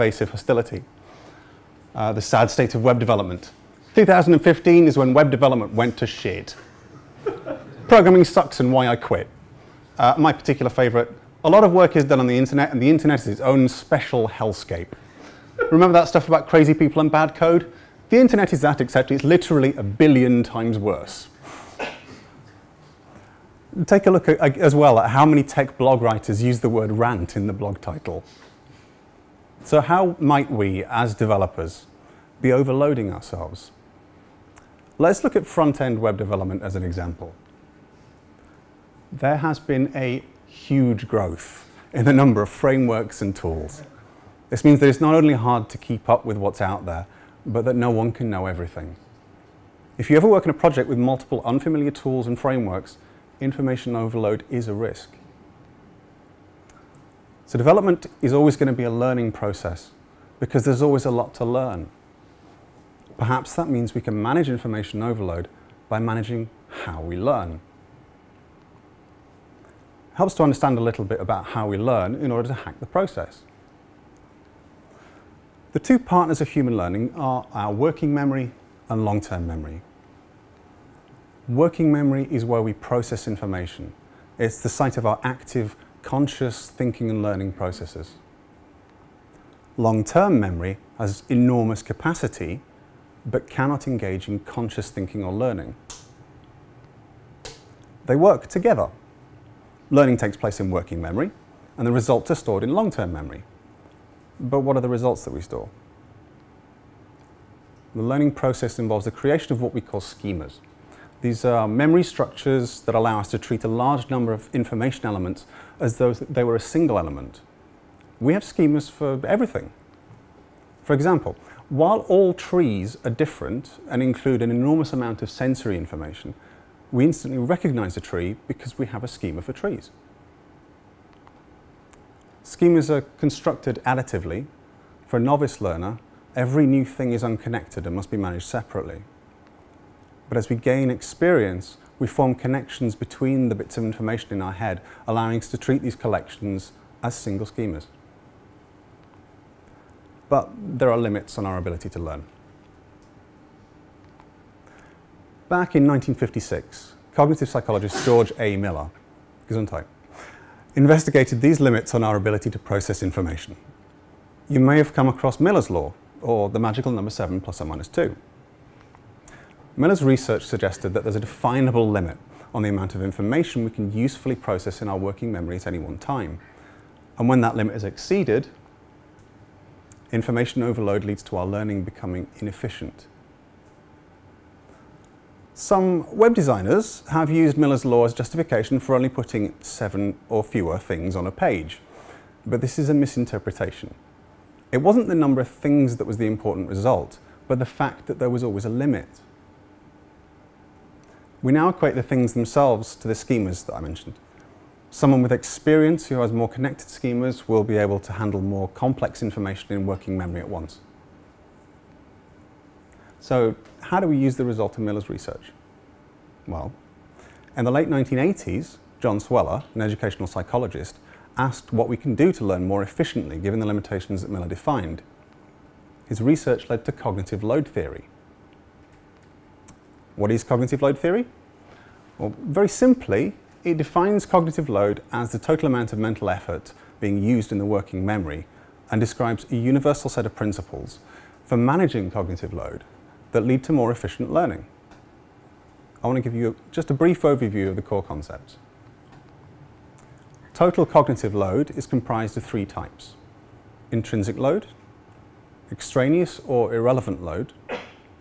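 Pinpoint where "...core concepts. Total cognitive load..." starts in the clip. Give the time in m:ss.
4:07.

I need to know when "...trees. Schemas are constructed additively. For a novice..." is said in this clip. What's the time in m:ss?
2:09.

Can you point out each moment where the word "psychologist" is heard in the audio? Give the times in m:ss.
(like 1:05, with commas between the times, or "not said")
2:37, 3:40.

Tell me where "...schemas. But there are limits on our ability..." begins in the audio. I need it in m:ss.
2:27.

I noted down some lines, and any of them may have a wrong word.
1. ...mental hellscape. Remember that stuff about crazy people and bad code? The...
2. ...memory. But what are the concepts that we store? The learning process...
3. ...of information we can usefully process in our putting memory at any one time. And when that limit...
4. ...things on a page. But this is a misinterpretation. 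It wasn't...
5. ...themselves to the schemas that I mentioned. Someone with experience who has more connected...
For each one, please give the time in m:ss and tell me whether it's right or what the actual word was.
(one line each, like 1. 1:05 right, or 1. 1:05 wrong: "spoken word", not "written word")
1. 0:13 wrong: "special", not "mental"
2. 1:43 wrong: "results", not "concepts"
3. 2:52 wrong: "working", not "putting"
4. 3:10 right
5. 3:22 right.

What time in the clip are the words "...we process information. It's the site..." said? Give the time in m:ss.
1:22.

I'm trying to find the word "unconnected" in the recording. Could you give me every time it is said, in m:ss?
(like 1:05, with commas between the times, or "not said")
2:17.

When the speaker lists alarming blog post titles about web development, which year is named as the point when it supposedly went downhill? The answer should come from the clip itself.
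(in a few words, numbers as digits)
2015.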